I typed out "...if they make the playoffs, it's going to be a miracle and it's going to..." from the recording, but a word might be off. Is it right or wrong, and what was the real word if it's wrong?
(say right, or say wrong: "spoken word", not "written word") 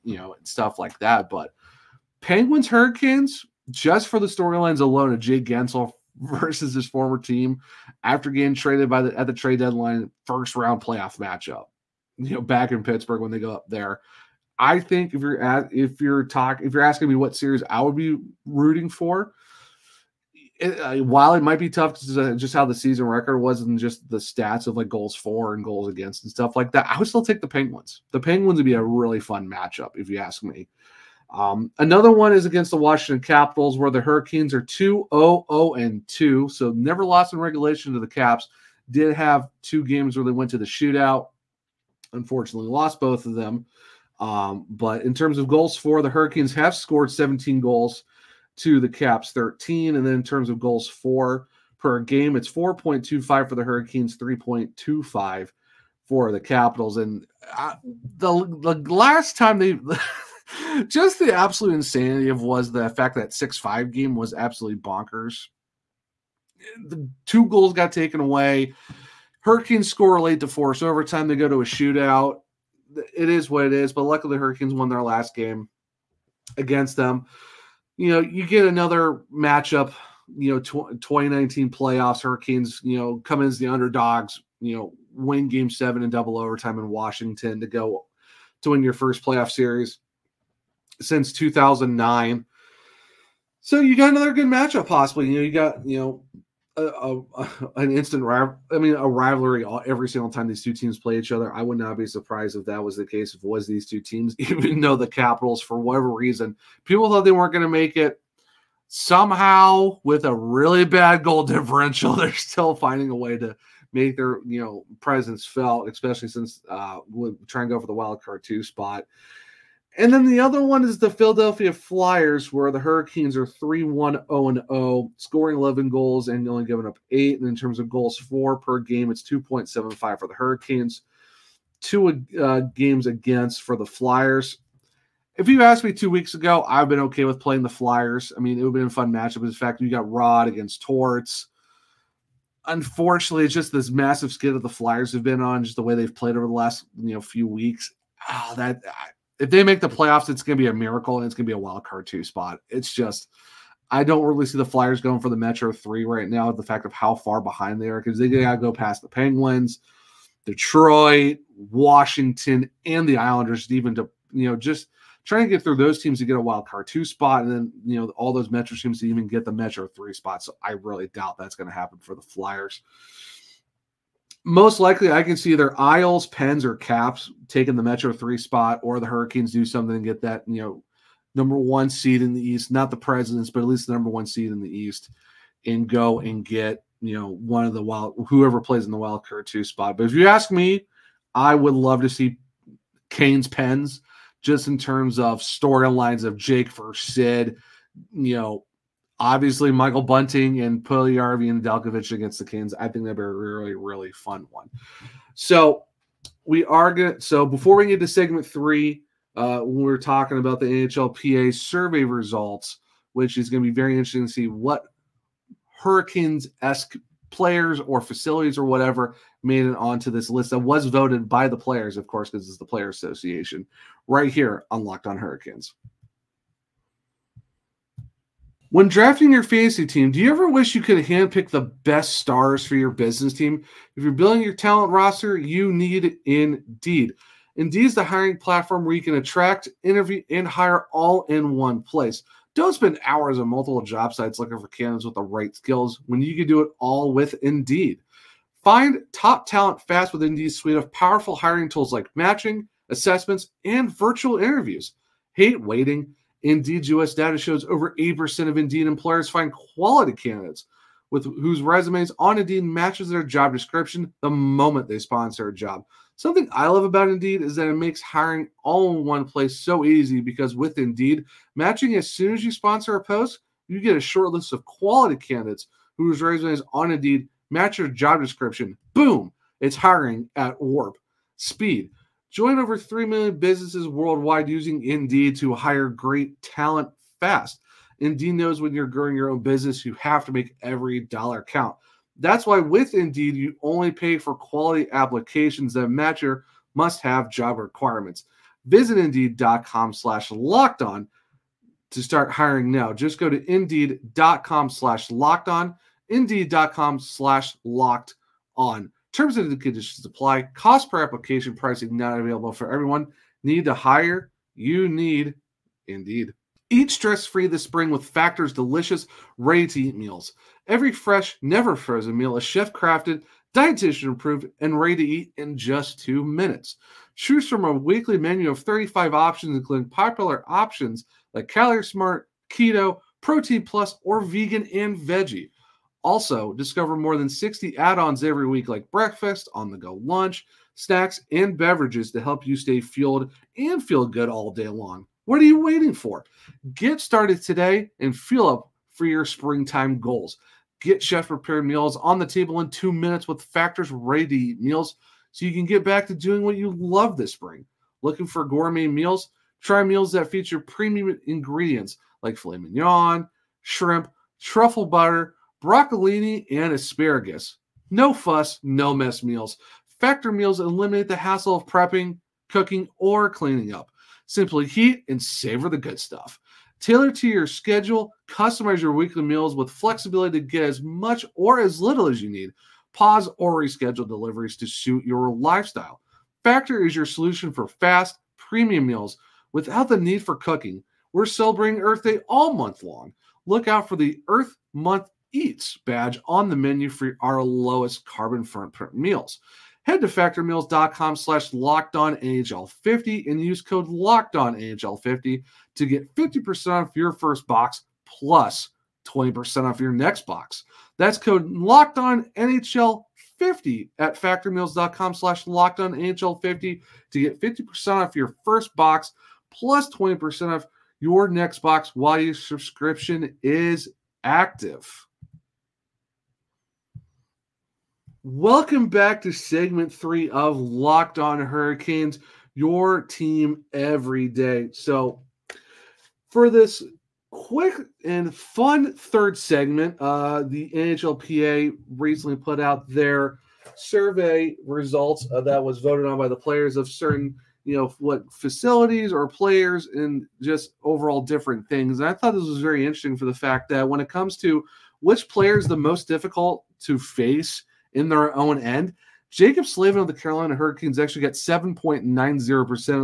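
right.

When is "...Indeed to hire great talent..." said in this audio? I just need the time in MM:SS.
04:44.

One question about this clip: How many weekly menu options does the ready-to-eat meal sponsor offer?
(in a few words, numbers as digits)
35.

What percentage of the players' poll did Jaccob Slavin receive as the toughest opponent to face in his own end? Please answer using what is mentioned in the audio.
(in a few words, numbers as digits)
7.90%.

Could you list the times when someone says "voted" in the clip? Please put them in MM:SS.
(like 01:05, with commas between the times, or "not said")
03:40, 07:25.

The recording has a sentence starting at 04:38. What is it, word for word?
Boom, it's hiring at warp speed.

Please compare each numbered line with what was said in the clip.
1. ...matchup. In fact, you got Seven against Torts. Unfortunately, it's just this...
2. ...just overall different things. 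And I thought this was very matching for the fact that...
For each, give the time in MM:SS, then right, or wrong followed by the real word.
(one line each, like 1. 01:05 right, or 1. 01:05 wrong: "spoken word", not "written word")
1. 02:19 wrong: "Rod", not "Seven"
2. 07:30 wrong: "interesting", not "matching".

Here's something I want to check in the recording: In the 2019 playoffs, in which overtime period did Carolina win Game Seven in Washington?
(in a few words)
double overtime.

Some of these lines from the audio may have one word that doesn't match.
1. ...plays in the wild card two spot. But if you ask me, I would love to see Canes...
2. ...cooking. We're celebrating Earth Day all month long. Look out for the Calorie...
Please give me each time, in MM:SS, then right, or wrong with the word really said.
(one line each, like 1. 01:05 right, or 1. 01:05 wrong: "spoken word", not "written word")
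1. 03:08 right
2. 06:30 wrong: "Earth", not "Calorie".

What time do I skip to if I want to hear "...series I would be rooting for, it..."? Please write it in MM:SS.
00:17.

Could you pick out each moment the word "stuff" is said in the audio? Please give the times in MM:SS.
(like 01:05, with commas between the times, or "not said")
00:00, 00:26, 06:15.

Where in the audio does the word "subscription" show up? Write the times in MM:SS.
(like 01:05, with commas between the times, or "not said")
07:02.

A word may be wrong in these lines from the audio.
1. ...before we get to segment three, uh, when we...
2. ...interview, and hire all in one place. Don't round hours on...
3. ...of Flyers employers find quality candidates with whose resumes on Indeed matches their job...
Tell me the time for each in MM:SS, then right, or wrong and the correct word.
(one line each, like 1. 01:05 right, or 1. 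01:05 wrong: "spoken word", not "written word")
1. 03:27 right
2. 03:59 wrong: "spend", not "round"
3. 04:18 wrong: "Indeed", not "Flyers".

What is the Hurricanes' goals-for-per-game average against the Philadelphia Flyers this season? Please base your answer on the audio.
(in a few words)
2.75.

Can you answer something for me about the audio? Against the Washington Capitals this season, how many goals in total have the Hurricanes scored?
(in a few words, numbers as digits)
17.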